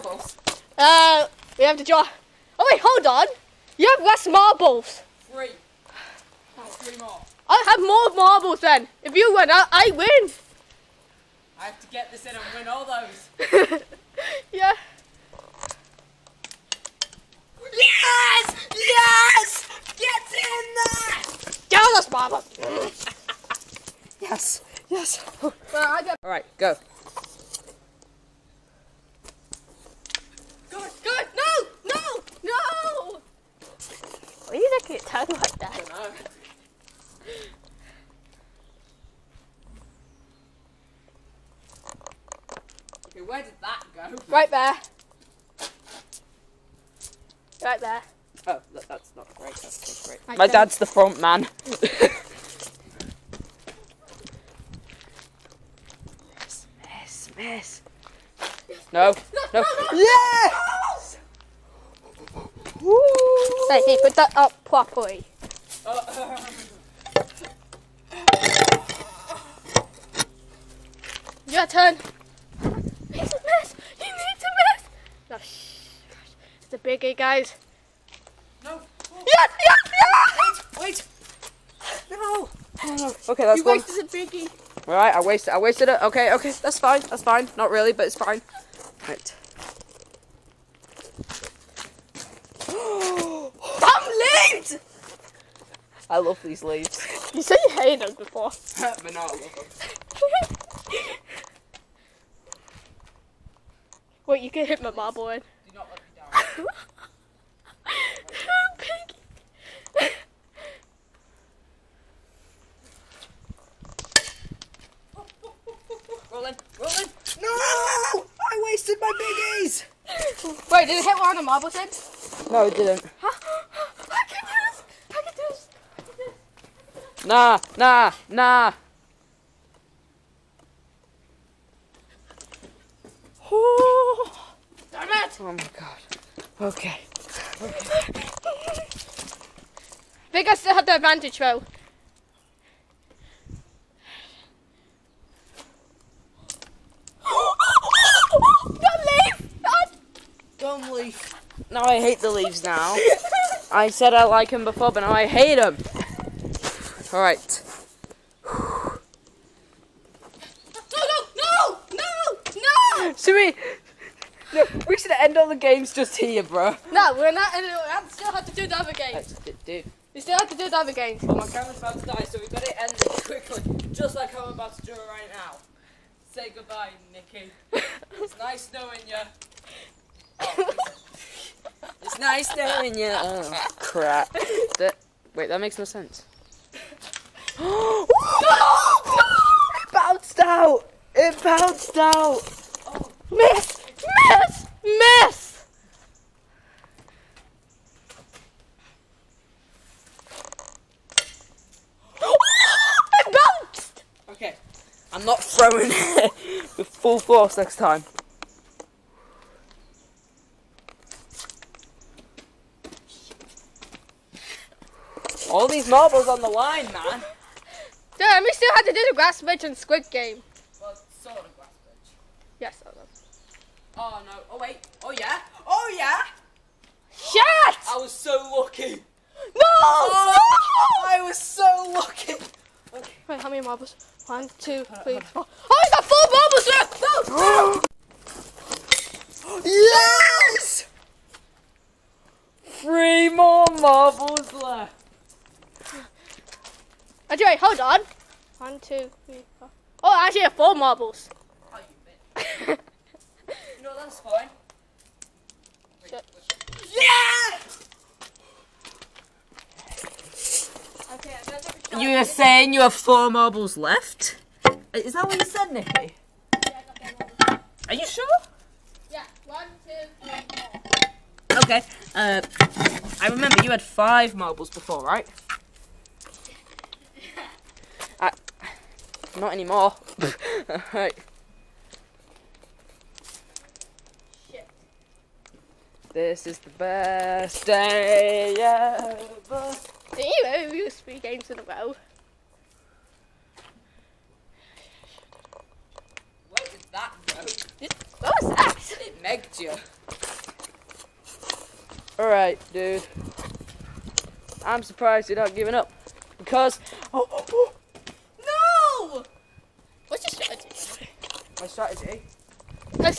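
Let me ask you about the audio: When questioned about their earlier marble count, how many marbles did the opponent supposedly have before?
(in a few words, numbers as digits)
5.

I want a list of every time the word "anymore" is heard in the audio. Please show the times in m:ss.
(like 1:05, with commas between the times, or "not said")
4:39.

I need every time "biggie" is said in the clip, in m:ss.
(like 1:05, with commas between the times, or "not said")
1:24, 1:59.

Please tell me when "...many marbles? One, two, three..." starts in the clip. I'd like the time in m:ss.
3:53.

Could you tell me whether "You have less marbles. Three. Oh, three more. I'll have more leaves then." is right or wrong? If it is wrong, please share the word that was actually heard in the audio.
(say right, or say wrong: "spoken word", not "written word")
wrong: "marbles", not "leaves".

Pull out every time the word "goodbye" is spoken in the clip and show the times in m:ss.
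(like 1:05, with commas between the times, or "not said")
2:56.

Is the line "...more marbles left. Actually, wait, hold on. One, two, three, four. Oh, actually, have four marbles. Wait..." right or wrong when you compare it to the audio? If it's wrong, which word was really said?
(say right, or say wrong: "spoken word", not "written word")
right.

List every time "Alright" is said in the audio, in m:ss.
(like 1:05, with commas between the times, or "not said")
2:37, 4:40, 5:02.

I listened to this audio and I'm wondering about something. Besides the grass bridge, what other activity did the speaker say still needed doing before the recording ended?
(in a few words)
Squid Game.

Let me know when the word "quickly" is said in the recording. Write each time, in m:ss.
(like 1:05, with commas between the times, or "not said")
2:53.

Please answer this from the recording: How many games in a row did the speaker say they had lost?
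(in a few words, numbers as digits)
3.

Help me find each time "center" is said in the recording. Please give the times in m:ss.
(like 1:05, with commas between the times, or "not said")
not said.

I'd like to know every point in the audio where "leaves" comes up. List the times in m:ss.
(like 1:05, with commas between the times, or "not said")
1:36, 2:32.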